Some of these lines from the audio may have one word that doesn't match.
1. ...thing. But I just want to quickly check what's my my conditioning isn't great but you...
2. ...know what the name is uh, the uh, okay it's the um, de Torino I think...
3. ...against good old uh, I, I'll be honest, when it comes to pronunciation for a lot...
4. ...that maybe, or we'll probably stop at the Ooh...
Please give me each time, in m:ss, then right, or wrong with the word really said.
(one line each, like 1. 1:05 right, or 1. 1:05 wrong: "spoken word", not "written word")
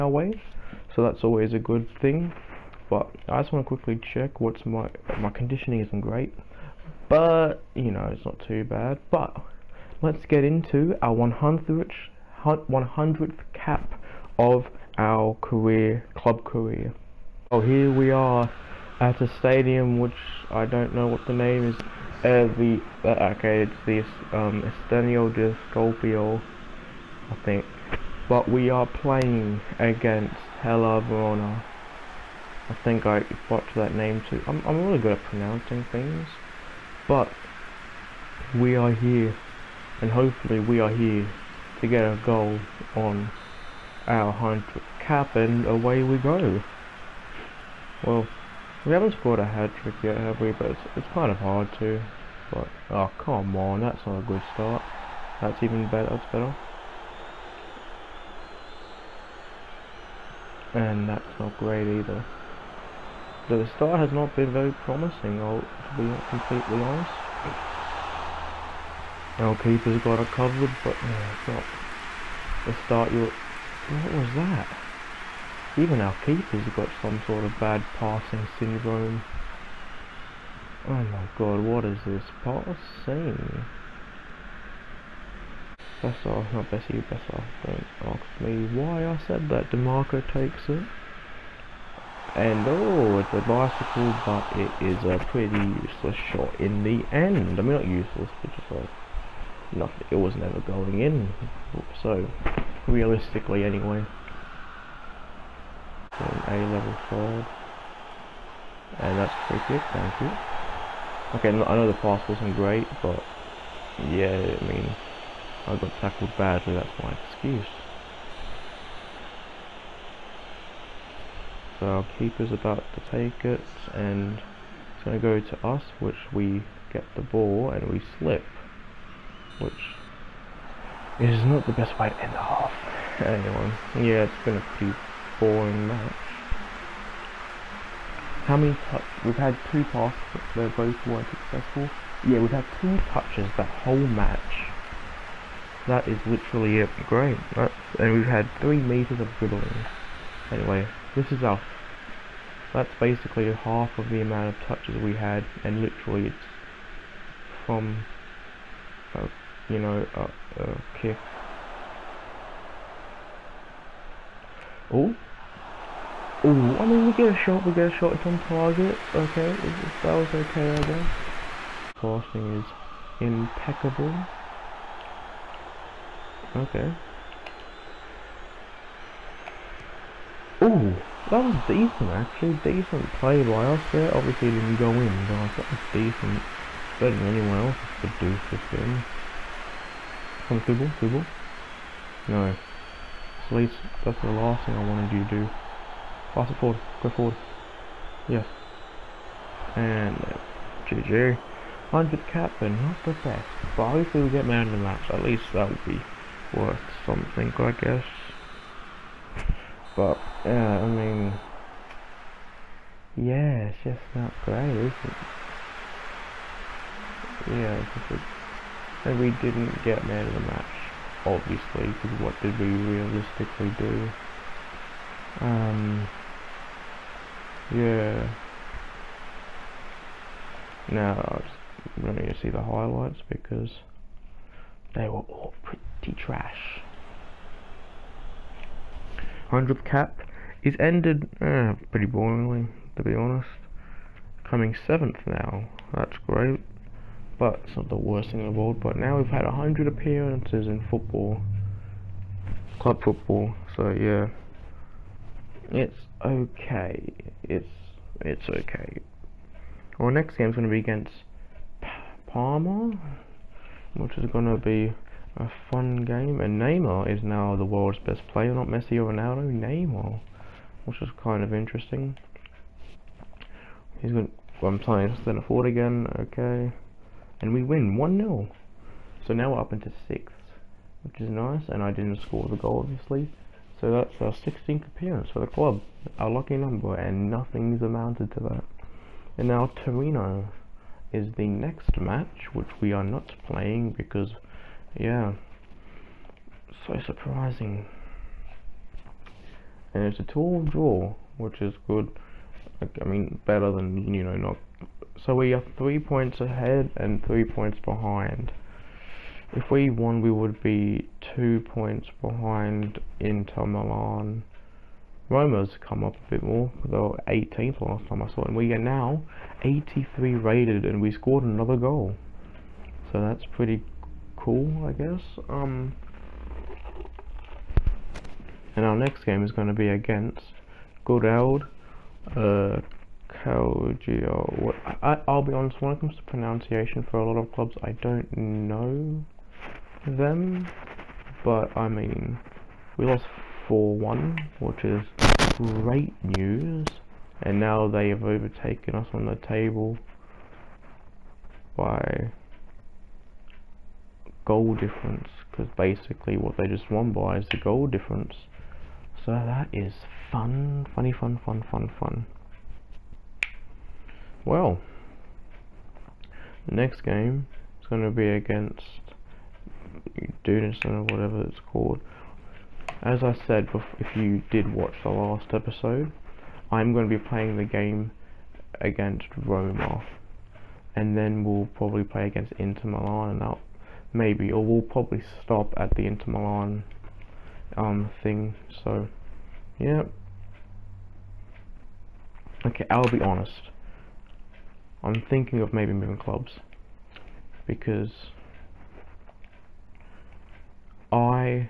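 1. 0:01 right
2. 0:20 wrong: "Scorpio", not "Torino"
3. 5:29 right
4. 6:23 wrong: "Inter", not "Ooh".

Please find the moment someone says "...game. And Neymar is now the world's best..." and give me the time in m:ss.
4:26.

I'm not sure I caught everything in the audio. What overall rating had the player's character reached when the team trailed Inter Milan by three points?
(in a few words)
83.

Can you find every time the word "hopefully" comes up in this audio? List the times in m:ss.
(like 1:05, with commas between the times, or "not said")
0:40, 3:23.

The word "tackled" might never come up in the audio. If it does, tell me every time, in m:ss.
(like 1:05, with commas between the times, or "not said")
1:55.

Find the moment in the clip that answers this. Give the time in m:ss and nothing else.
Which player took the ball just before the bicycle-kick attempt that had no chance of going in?
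1:29.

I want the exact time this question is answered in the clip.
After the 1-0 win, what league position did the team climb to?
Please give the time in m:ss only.
4:40.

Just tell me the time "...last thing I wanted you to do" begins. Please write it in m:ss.
3:14.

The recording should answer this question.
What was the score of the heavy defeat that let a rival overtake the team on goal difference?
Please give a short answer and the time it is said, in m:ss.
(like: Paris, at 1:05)
4-1, at 5:43.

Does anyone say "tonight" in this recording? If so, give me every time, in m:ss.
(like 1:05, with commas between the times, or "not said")
not said.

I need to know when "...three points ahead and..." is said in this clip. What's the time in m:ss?
5:05.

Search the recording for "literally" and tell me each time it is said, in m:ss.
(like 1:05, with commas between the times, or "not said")
2:26, 2:35.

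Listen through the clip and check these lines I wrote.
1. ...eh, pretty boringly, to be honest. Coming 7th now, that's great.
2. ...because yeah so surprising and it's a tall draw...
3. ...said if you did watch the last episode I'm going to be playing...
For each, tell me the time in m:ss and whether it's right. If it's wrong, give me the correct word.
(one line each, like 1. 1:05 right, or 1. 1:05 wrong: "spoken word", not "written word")
1. 4:01 right
2. 4:53 right
3. 6:13 right.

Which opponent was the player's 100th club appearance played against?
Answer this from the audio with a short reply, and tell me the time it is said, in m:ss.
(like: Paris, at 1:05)
Hellas Verona, at 0:30.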